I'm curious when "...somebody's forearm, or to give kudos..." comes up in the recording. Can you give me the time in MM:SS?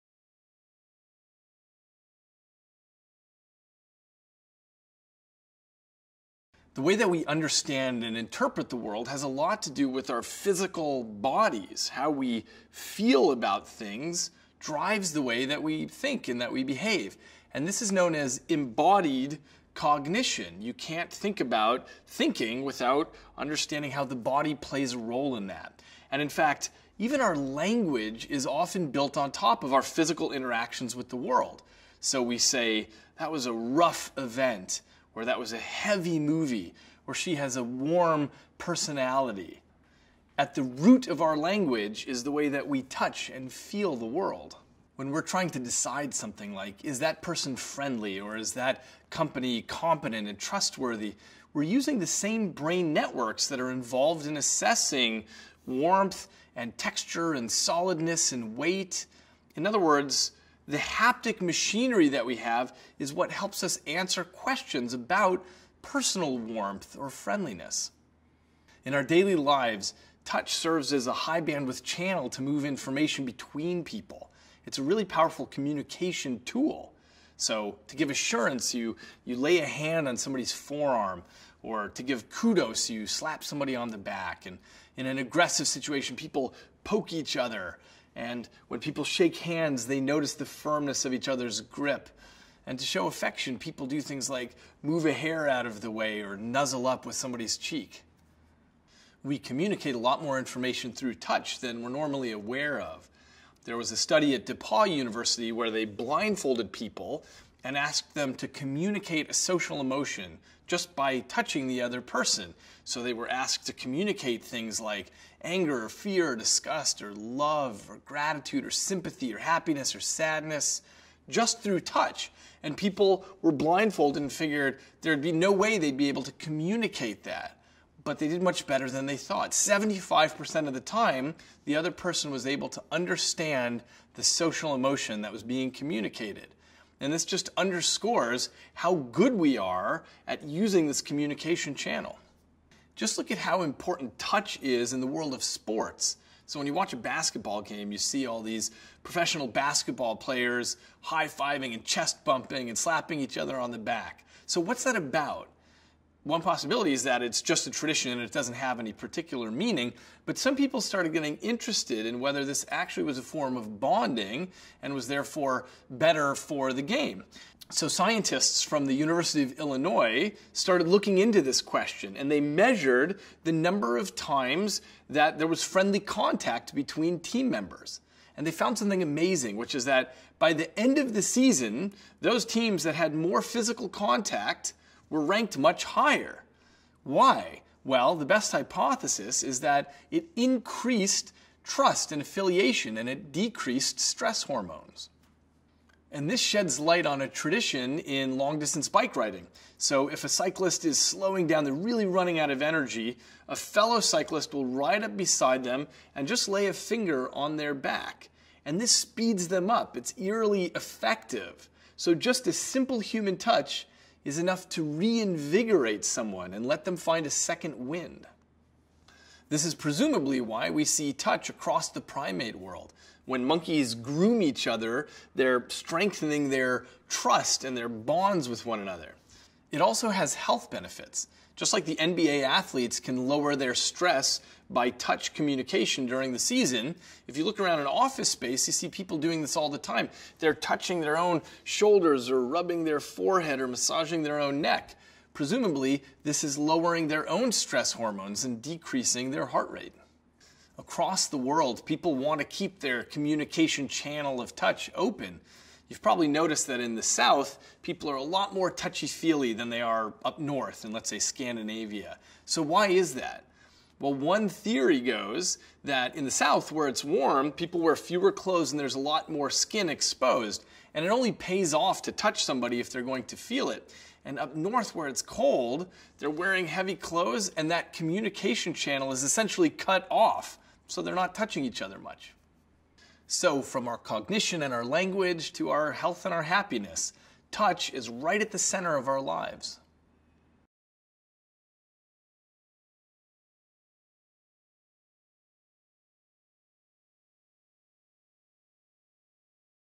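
01:20.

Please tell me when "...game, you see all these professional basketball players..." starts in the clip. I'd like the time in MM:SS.
02:27.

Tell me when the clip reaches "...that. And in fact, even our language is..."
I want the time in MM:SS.
00:25.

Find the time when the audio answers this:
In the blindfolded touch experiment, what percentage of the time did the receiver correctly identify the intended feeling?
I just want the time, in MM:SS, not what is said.
02:09.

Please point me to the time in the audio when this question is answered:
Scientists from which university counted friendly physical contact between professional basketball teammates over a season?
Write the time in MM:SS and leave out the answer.
02:48.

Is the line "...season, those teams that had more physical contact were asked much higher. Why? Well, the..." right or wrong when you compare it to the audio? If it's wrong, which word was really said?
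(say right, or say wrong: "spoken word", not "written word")
wrong: "ranked", not "asked".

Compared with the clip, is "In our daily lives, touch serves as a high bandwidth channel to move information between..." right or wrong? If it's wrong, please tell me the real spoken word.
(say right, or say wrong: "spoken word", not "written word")
right.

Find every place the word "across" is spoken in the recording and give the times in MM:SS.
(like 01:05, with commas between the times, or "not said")
03:41, 04:10.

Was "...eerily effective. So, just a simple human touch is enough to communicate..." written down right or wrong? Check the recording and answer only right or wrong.
wrong.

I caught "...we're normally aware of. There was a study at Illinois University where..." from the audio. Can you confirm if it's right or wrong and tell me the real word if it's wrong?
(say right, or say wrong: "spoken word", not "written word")
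wrong: "DePauw", not "Illinois".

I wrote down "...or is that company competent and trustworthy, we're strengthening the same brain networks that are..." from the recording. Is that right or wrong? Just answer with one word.
wrong.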